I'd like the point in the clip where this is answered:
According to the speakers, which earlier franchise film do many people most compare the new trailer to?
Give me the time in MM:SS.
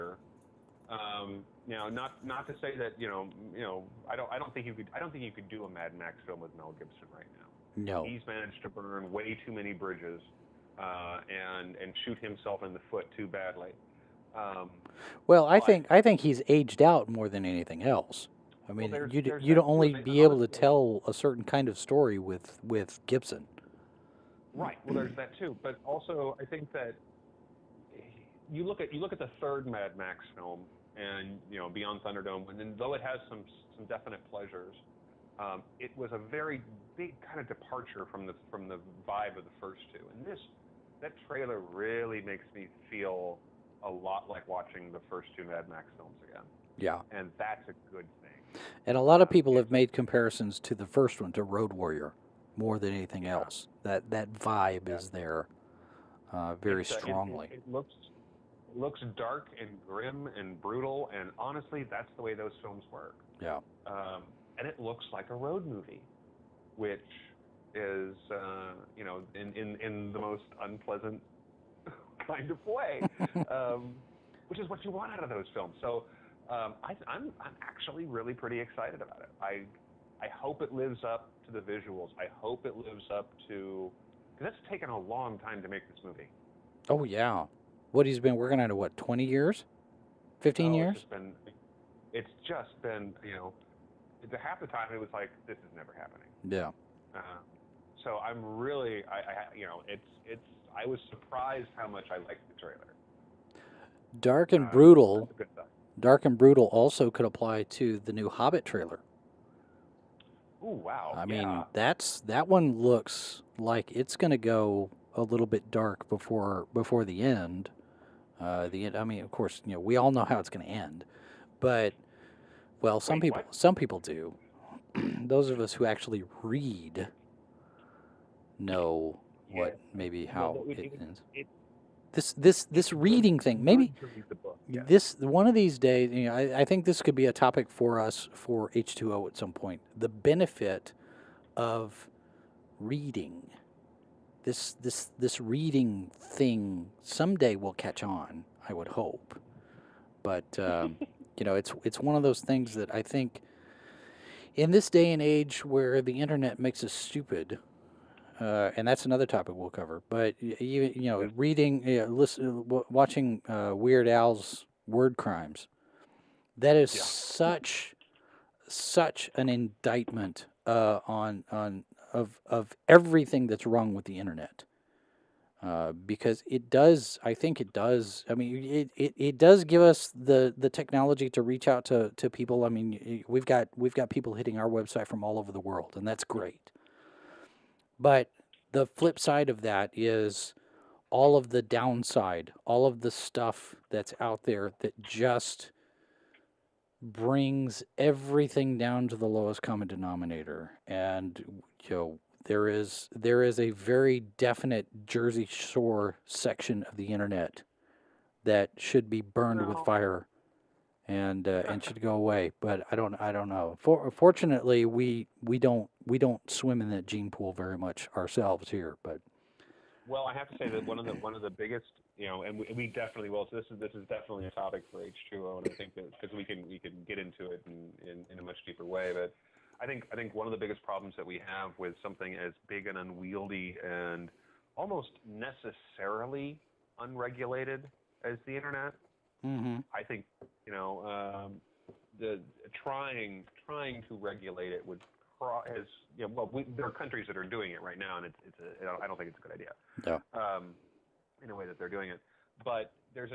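00:51.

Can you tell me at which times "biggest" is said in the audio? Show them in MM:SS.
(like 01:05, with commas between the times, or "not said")
03:41, 03:50.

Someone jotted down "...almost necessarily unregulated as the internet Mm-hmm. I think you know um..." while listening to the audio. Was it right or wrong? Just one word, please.
right.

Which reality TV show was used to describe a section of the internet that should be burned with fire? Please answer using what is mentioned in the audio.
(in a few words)
Jersey Shore.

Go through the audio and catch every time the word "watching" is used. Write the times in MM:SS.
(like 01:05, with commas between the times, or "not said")
00:44, 02:42.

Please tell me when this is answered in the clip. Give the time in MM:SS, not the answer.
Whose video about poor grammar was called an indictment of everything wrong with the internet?
02:43.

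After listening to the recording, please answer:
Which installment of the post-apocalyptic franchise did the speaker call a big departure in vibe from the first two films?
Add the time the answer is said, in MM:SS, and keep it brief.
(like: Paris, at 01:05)
Beyond Thunderdome, at 00:31.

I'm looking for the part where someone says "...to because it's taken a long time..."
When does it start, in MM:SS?
01:23.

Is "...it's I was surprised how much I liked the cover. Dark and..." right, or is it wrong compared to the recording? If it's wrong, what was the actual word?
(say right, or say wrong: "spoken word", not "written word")
wrong: "trailer", not "cover".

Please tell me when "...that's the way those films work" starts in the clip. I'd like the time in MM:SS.
01:01.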